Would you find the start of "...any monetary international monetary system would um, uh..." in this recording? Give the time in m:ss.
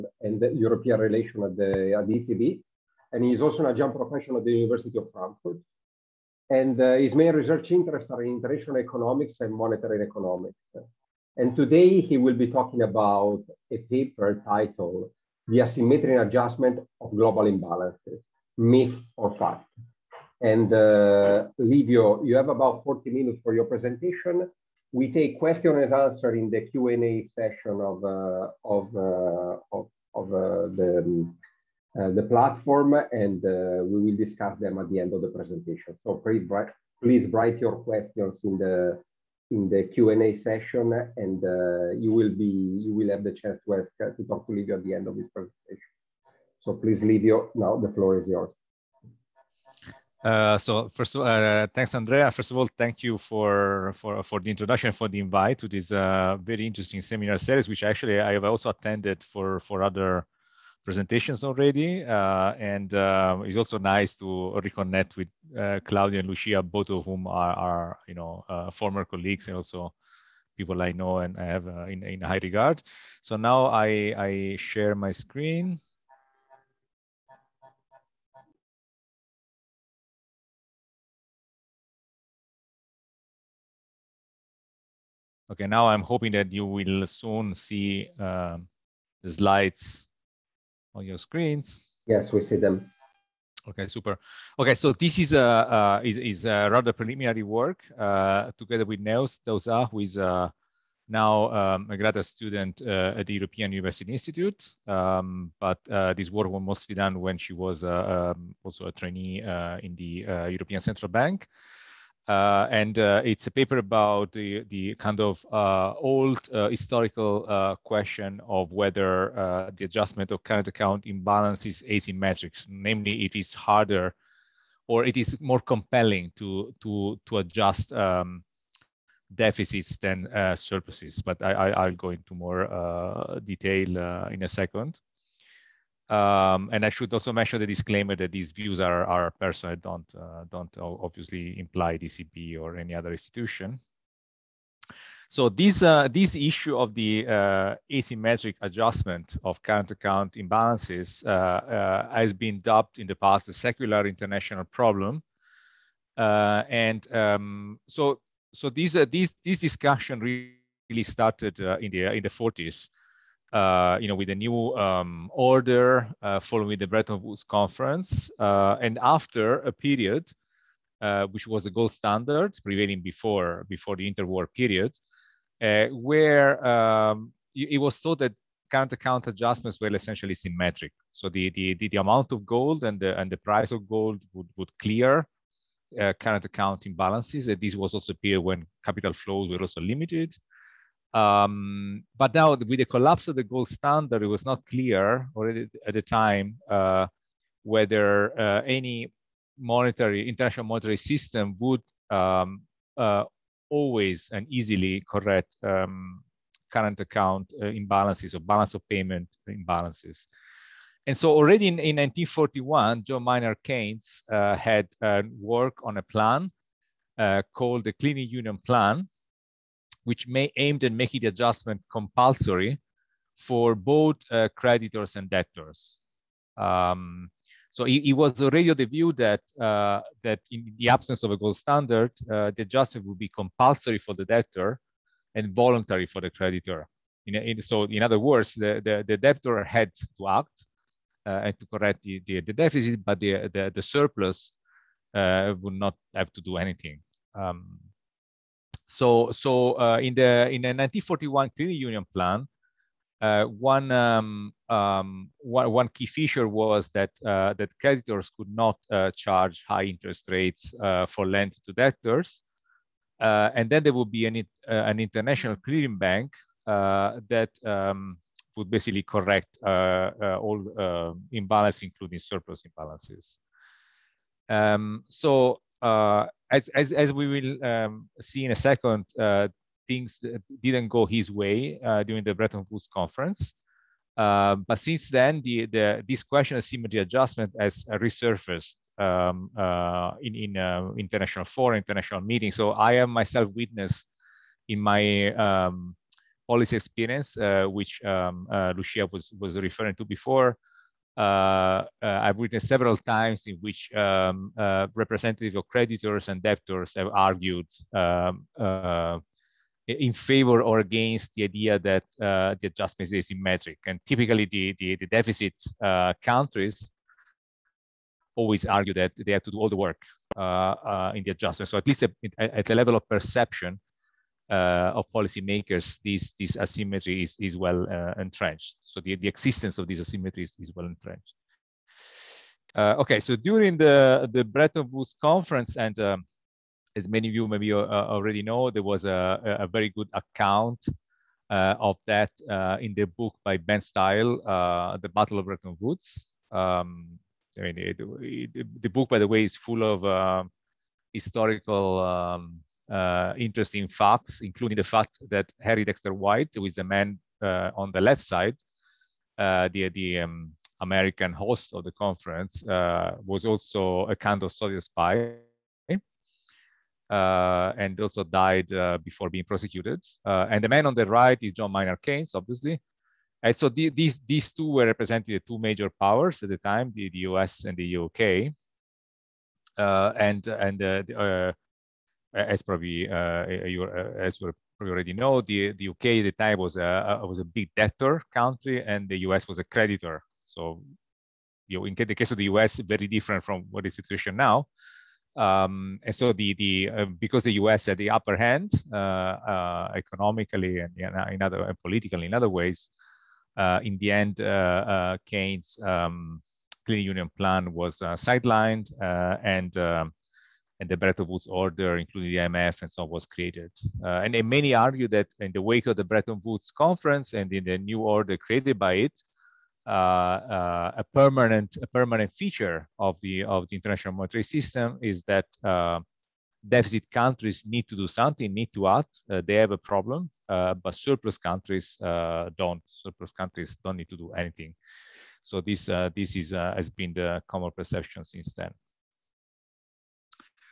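3:18.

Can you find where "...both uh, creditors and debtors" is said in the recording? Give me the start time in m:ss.
3:43.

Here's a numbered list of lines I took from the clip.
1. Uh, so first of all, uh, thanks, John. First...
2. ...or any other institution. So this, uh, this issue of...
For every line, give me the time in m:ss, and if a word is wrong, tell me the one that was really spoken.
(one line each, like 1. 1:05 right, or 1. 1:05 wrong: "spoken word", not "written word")
1. 0:50 wrong: "Andrea", not "John"
2. 2:22 right.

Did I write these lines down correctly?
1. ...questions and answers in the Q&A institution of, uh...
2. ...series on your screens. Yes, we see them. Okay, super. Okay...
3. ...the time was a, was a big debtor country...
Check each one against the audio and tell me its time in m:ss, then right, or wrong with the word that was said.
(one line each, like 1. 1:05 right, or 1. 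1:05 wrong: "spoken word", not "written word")
1. 0:25 wrong: "session", not "institution"
2. 1:29 wrong: "slides", not "series"
3. 6:26 right.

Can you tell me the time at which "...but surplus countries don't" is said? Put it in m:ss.
7:10.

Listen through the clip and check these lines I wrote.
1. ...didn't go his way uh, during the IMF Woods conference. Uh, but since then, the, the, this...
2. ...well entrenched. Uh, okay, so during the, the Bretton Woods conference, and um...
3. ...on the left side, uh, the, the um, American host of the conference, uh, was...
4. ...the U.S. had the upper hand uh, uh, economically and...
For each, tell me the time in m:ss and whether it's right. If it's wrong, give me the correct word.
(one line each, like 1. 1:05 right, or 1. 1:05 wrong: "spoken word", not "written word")
1. 4:40 wrong: "Bretton", not "IMF"
2. 5:30 right
3. 5:57 right
4. 6:37 right.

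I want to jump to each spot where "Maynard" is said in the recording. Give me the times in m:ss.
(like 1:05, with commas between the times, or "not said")
3:33, 6:11.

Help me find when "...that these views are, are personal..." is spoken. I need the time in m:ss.
2:18.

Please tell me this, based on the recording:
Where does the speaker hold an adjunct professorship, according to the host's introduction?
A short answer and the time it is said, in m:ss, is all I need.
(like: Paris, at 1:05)
University of Frankfurt, at 0:04.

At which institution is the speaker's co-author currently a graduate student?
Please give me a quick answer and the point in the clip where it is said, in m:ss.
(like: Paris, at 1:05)
European University Institute, at 1:43.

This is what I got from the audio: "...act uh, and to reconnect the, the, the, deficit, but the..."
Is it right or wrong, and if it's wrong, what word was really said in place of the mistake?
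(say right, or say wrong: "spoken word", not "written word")
wrong: "correct", not "reconnect".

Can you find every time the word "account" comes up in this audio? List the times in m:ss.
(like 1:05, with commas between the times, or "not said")
2:00, 2:29, 2:58, 3:06, 3:26, 5:40.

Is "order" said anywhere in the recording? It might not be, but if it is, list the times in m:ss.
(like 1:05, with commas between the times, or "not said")
2:45, 6:51, 6:57.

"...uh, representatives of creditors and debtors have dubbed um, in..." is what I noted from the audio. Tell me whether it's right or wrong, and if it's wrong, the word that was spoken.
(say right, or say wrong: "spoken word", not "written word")
wrong: "argued", not "dubbed".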